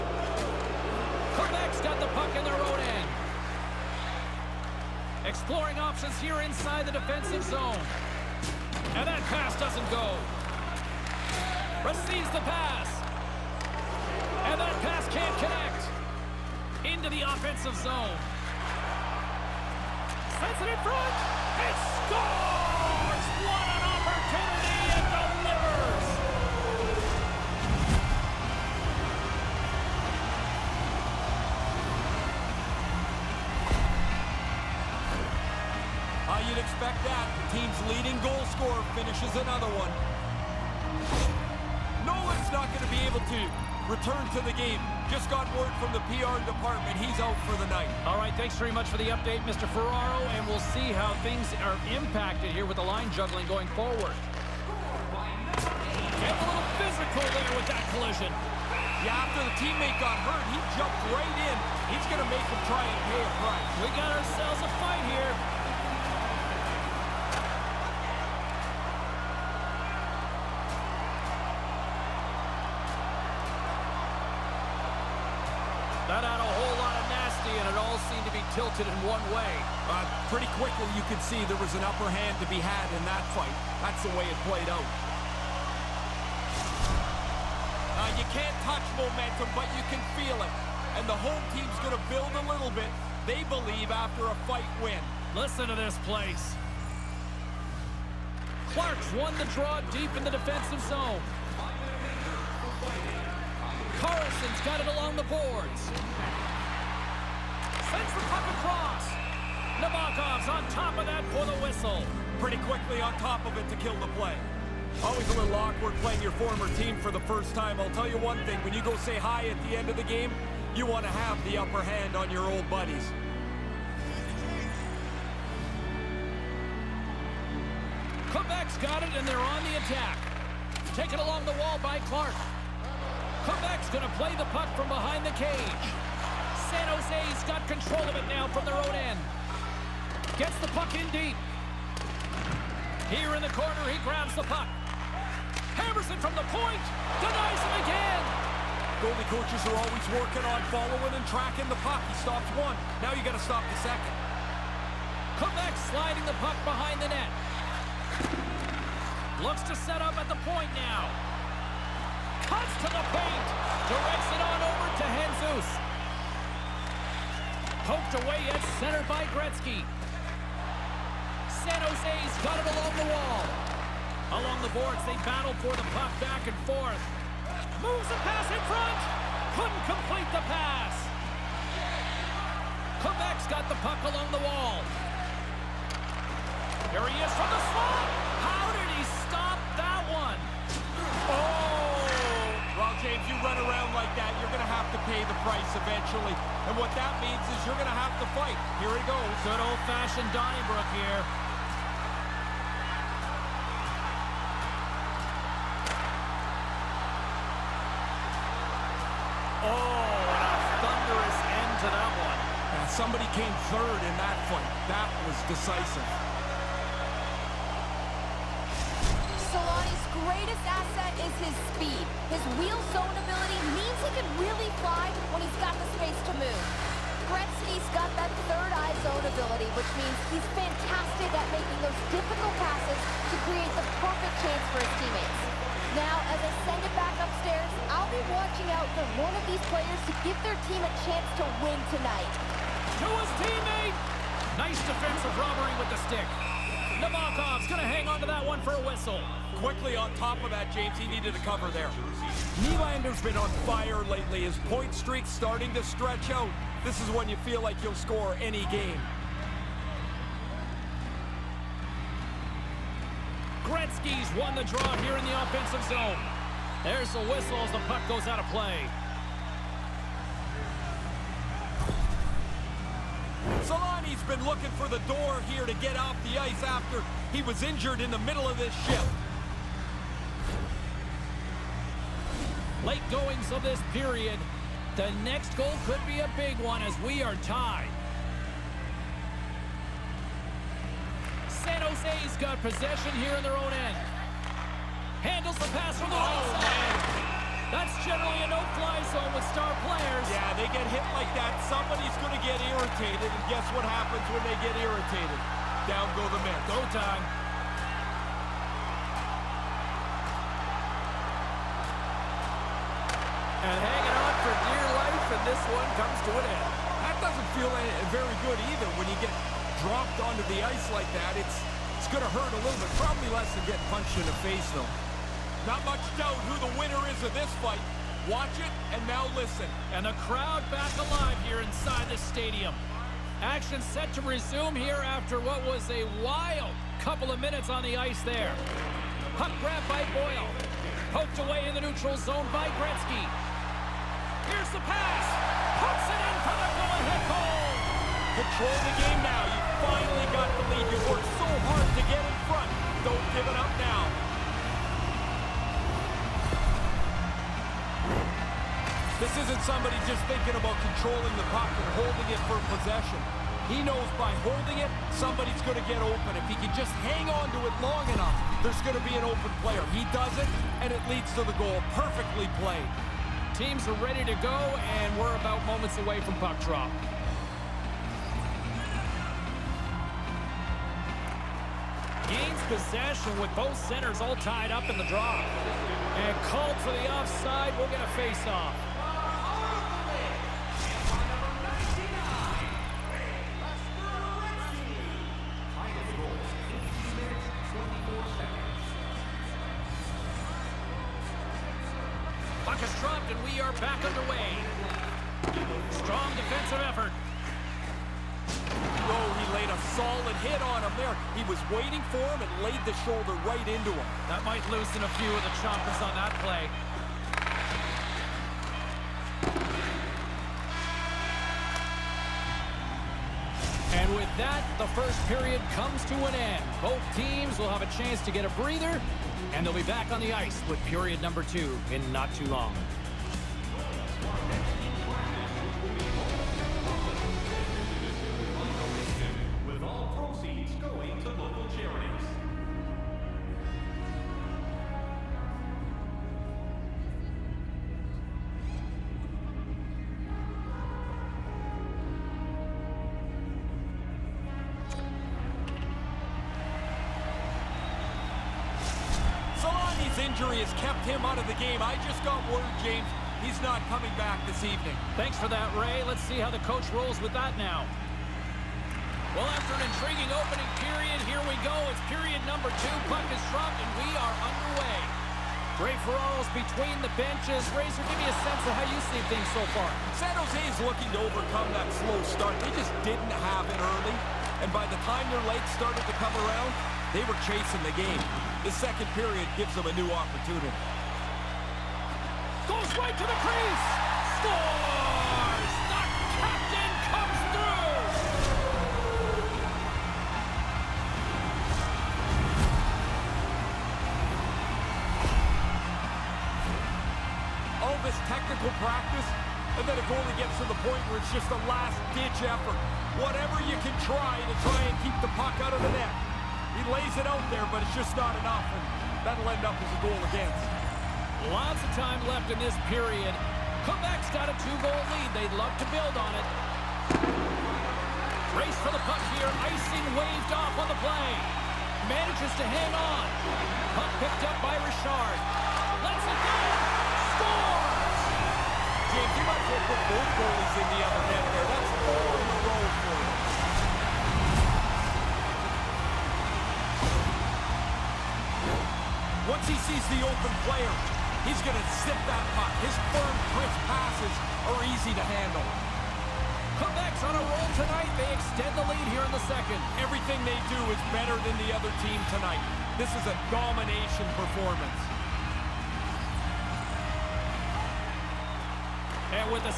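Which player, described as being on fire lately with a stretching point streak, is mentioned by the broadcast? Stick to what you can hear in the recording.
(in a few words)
Nylander.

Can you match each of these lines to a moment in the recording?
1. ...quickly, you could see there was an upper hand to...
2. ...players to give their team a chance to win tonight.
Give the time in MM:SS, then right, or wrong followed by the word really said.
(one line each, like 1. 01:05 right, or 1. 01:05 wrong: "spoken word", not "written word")
1. 01:20 right
2. 03:59 right.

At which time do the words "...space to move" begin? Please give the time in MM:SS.
03:45.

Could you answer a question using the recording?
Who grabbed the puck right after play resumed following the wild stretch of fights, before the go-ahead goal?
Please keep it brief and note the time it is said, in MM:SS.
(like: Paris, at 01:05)
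Boyle, at 05:39.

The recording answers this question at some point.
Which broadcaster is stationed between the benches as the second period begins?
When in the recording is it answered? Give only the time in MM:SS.
07:55.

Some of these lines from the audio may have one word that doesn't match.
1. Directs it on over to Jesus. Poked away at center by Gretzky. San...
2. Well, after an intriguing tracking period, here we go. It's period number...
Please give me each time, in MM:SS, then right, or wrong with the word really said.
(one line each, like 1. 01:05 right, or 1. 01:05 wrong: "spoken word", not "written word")
1. 02:43 right
2. 07:49 wrong: "opening", not "tracking".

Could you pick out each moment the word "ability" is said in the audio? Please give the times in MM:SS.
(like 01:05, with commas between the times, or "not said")
03:43, 03:49.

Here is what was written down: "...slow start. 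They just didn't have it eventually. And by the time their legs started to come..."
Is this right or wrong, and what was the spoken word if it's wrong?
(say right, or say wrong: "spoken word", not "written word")
wrong: "early", not "eventually".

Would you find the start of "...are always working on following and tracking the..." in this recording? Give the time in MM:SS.
02:29.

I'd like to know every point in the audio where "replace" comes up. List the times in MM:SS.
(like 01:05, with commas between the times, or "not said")
not said.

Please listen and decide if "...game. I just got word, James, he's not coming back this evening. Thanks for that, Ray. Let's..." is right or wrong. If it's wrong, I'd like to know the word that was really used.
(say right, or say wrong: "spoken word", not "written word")
right.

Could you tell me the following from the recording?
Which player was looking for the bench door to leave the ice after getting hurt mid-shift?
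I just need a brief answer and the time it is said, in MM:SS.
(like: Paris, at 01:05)
Solani, at 04:33.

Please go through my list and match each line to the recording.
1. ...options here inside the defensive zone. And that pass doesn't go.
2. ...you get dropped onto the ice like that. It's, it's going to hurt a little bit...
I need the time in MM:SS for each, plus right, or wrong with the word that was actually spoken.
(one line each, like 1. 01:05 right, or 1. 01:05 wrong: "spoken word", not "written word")
1. 00:05 right
2. 05:19 right.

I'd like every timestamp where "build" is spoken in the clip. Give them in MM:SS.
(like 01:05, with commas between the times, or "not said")
01:32, 08:45.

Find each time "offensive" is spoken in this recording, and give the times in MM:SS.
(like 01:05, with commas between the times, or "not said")
00:17, 04:25.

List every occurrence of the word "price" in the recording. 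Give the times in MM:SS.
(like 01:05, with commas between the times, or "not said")
01:03, 03:15.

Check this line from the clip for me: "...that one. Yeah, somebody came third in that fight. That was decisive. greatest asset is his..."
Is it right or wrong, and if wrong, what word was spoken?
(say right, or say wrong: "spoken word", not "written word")
right.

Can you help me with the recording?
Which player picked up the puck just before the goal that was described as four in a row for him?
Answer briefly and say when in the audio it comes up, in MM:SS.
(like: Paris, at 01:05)
Richard, at 08:53.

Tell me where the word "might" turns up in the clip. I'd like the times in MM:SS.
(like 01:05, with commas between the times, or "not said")
06:54, 08:59.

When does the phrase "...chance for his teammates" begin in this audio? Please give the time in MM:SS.
03:54.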